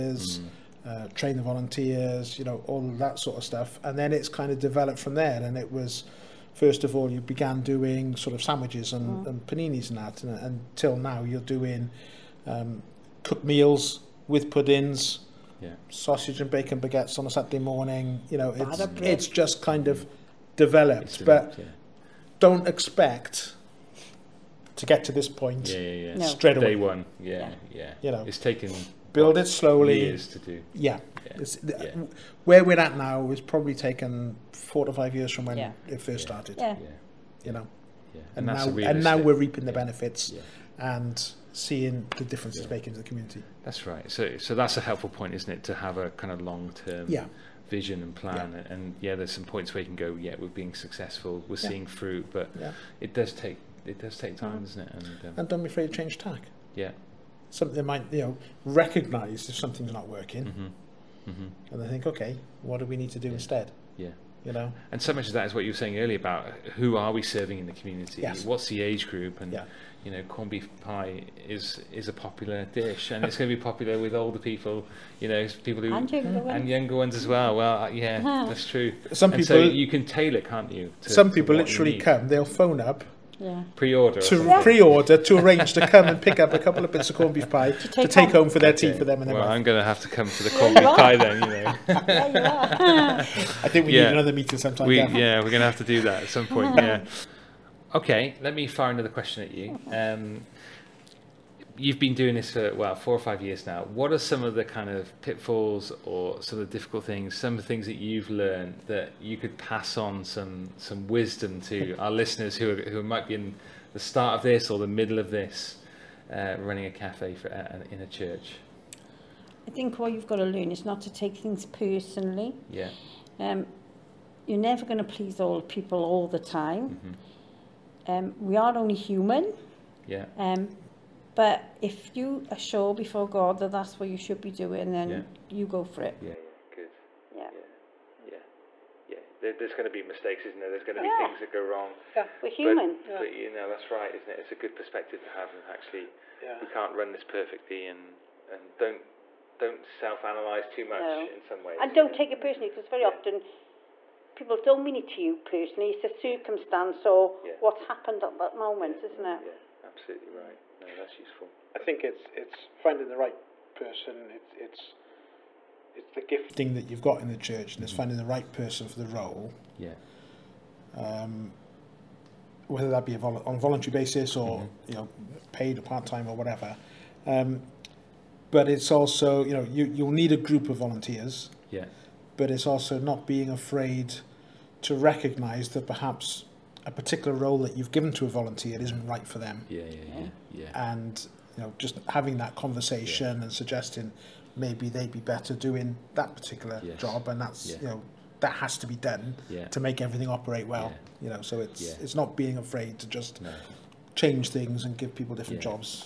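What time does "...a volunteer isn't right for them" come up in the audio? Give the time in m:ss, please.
3:08.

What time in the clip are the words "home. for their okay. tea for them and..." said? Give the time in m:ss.
1:28.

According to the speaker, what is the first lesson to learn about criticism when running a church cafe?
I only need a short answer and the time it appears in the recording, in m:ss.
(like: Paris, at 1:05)
Not to take things personally, at 2:00.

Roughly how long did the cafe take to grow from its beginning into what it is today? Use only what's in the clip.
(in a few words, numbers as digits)
4 to 5 years.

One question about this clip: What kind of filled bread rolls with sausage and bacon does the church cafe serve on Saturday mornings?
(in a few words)
Baguettes.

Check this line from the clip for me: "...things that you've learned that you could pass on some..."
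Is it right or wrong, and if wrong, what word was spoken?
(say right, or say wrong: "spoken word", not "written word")
right.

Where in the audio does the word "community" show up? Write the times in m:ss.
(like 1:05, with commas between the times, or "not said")
0:43, 1:07.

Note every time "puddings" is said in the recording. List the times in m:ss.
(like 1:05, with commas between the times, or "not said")
0:14.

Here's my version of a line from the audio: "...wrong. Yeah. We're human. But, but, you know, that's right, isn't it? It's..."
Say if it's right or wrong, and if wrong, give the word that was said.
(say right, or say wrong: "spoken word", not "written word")
right.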